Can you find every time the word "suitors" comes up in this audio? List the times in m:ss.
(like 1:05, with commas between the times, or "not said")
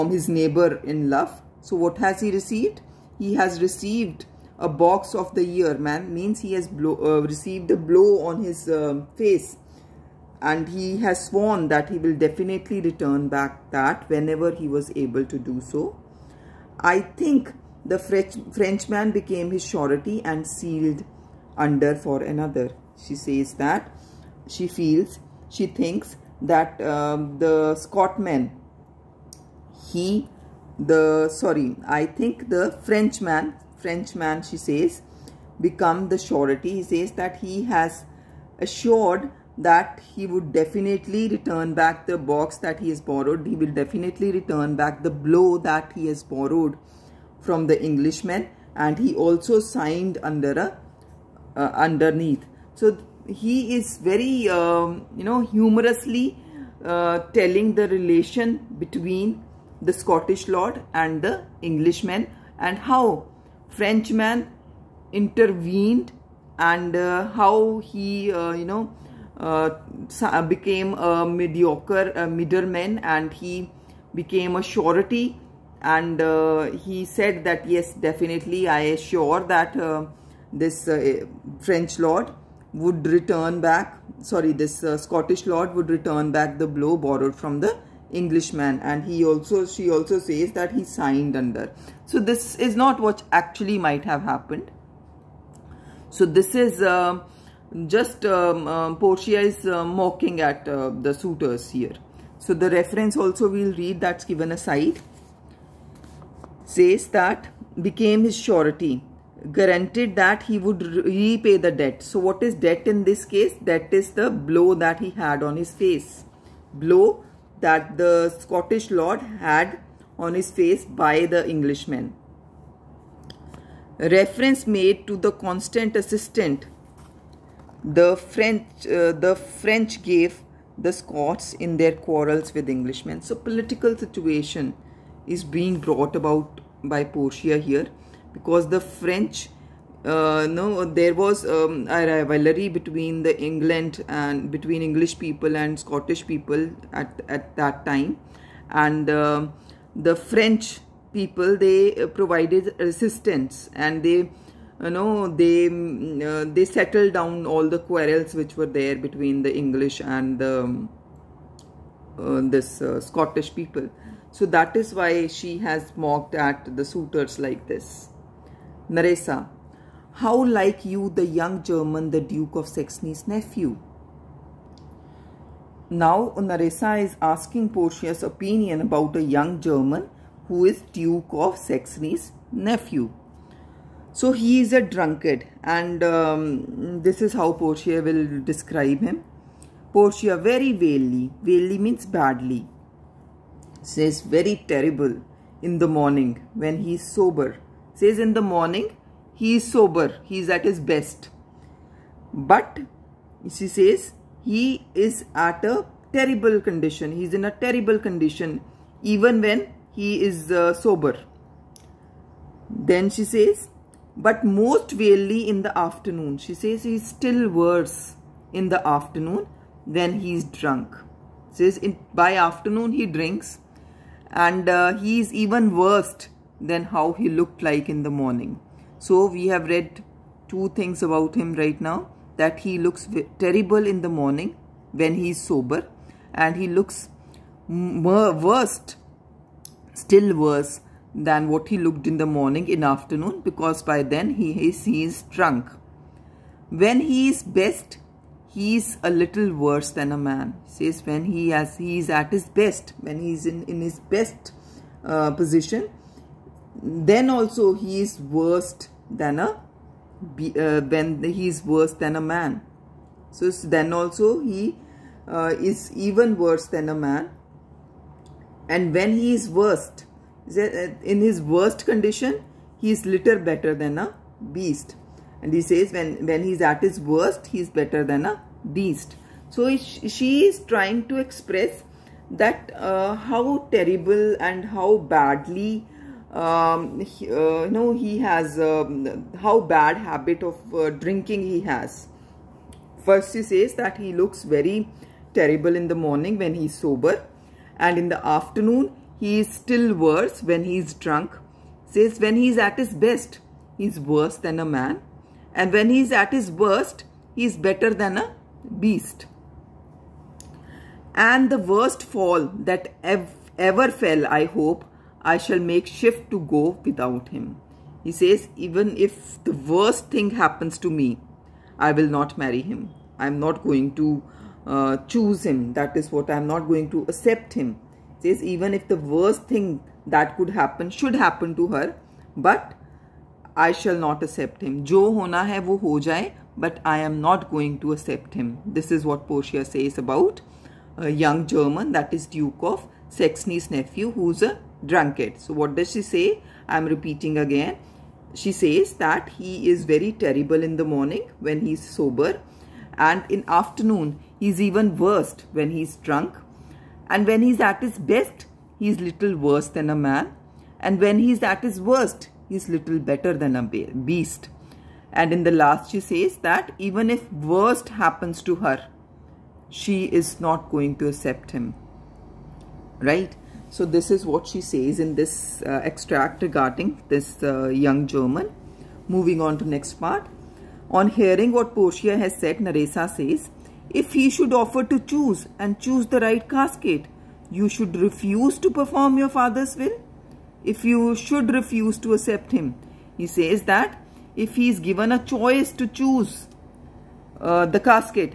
1:41, 2:46.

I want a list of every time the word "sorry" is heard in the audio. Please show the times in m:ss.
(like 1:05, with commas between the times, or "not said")
0:31, 1:24.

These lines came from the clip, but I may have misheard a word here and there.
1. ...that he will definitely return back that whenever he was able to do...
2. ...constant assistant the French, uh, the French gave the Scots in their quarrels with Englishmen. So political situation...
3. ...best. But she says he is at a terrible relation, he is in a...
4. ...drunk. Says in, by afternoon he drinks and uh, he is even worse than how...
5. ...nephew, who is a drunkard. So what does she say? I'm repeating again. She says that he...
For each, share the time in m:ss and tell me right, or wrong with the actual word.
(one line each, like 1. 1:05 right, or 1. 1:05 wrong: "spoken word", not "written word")
1. 0:11 right
2. 2:05 right
3. 3:20 wrong: "condition", not "relation"
4. 3:40 right
5. 5:43 right.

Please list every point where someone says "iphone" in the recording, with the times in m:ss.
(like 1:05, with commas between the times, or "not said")
not said.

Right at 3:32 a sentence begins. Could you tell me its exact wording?
Then she says, but most rarely in the afternoon.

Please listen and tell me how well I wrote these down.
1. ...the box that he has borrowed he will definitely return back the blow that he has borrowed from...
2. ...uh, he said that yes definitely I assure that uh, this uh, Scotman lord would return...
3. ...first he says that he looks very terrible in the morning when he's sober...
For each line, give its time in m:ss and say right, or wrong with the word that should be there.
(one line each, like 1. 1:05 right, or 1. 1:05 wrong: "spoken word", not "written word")
1. 0:42 right
2. 1:16 wrong: "French", not "Scotman"
3. 4:53 right.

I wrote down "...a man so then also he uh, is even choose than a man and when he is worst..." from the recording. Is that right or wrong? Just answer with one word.
wrong.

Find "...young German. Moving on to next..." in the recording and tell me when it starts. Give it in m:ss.
6:17.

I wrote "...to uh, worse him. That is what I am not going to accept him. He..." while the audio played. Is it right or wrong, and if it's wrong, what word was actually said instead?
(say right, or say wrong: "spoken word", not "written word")
wrong: "choose", not "worse".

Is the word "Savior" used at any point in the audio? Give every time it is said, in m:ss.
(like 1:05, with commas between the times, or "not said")
not said.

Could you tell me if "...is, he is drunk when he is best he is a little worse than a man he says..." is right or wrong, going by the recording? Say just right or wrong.
right.